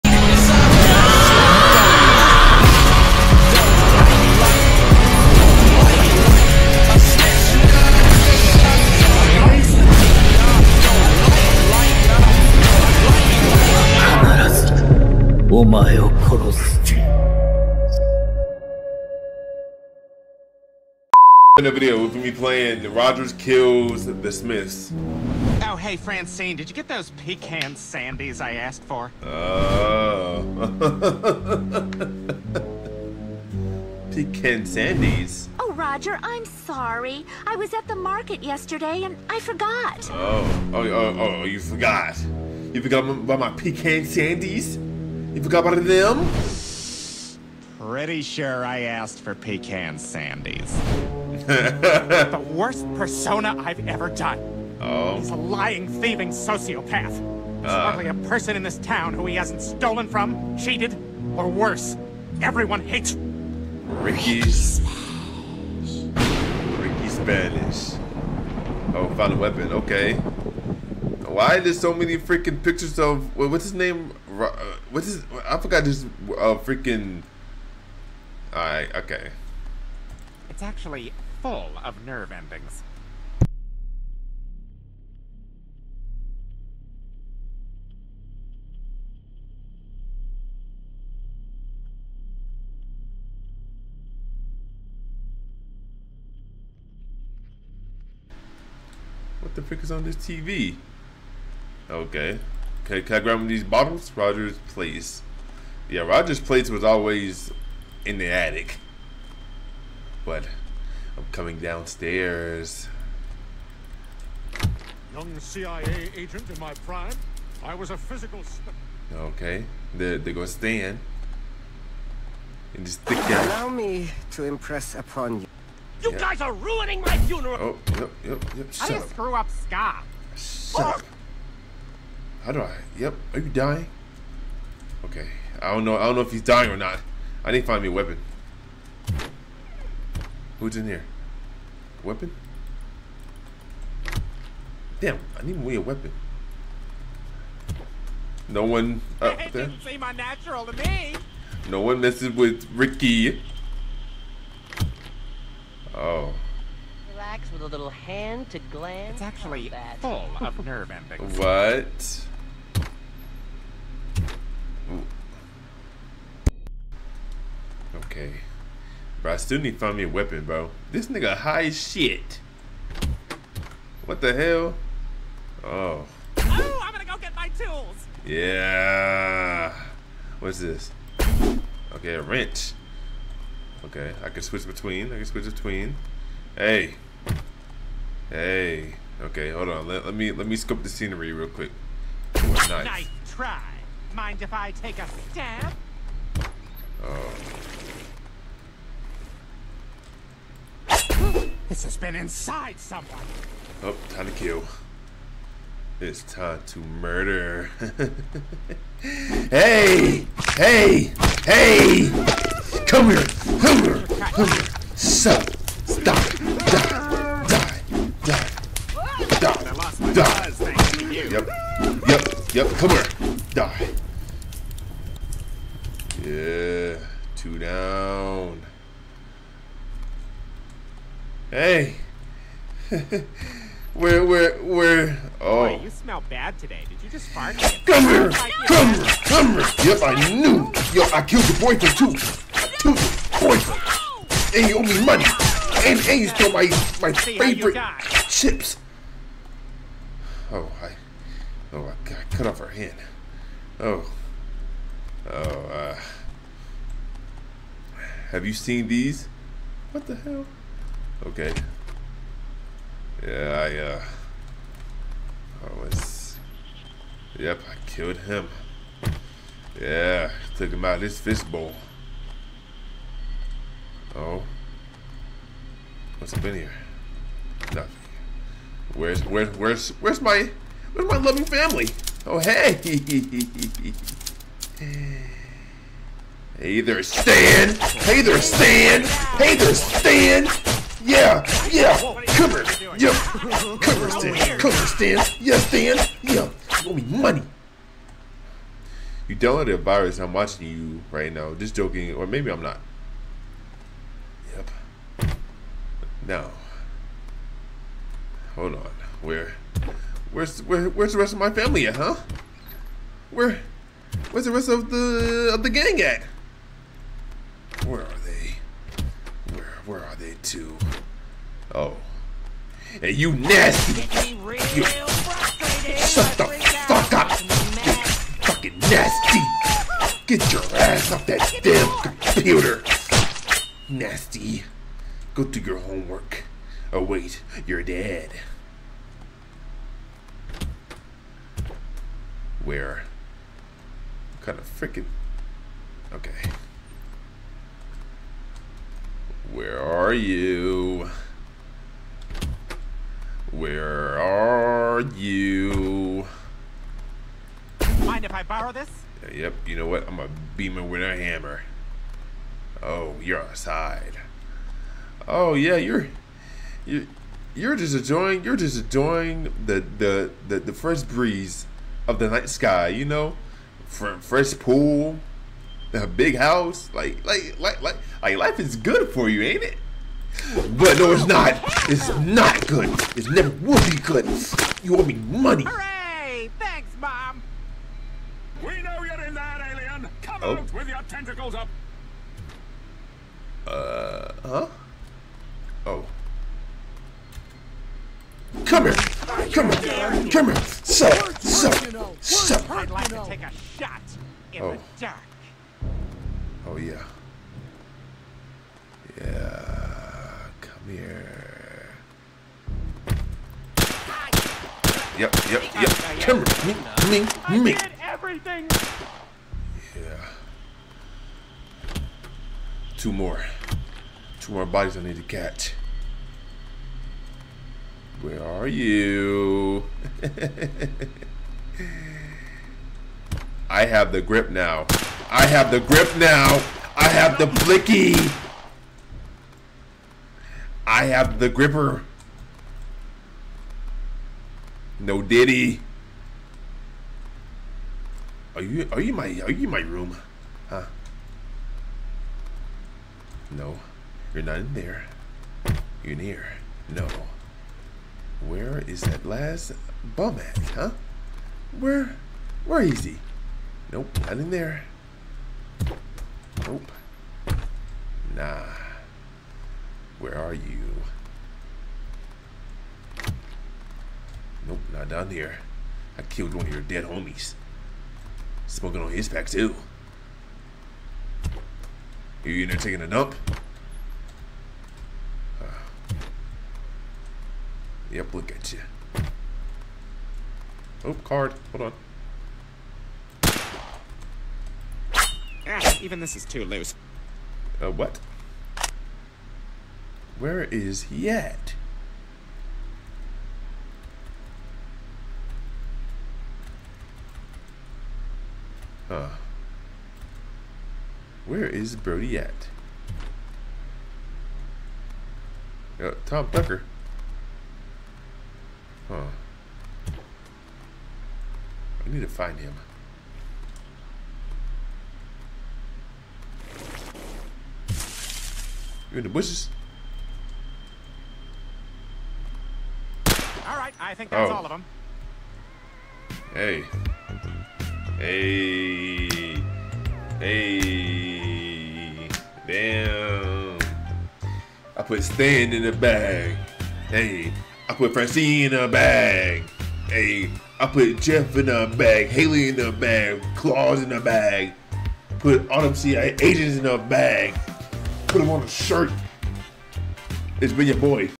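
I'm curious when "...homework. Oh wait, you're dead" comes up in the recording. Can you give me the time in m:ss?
5:35.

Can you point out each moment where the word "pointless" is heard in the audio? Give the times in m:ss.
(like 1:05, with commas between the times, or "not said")
not said.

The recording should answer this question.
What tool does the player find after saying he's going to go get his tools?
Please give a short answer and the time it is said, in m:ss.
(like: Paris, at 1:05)
A wrench, at 3:02.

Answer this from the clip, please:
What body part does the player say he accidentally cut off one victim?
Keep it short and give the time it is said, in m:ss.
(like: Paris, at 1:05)
Her hand, at 4:12.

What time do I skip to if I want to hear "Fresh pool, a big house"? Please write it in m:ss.
6:13.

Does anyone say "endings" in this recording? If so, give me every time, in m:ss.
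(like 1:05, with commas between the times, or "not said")
1:22, 2:40.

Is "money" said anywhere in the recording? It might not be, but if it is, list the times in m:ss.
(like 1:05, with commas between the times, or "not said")
4:05, 4:57, 6:25.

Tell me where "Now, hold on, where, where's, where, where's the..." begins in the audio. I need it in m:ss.
5:06.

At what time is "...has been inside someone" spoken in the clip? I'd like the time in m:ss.
3:21.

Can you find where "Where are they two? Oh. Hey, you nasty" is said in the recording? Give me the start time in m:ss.
5:19.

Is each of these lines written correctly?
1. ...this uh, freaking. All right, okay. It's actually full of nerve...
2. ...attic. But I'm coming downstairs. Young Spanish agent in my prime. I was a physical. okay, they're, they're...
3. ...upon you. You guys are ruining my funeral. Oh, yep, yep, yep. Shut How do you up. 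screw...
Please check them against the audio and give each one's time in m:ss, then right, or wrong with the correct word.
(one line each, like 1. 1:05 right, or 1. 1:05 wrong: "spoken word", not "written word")
1. 1:15 right
2. 1:48 wrong: "CIA", not "Spanish"
3. 2:04 right.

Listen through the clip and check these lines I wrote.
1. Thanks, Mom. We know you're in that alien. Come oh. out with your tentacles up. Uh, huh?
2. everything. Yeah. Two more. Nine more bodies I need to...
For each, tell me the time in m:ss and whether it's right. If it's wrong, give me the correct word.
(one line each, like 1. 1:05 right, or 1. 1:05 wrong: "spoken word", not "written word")
1. 6:26 right
2. 6:58 wrong: "Two", not "Nine".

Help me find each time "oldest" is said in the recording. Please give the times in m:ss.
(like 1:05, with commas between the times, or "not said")
not said.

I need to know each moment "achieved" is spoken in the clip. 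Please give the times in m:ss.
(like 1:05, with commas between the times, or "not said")
not said.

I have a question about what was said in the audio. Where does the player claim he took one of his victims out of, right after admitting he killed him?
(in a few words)
Fishbowl.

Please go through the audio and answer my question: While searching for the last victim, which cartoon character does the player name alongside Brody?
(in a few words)
Tom Tucker.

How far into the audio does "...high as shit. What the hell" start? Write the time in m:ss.
2:51.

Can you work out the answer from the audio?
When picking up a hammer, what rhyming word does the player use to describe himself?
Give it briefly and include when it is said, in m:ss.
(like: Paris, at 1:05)
A beamer, at 6:00.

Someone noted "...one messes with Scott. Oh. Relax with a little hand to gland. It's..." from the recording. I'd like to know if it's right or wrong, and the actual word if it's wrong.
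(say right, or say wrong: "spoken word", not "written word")
wrong: "Ricky", not "Scott".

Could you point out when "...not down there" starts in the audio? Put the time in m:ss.
7:54.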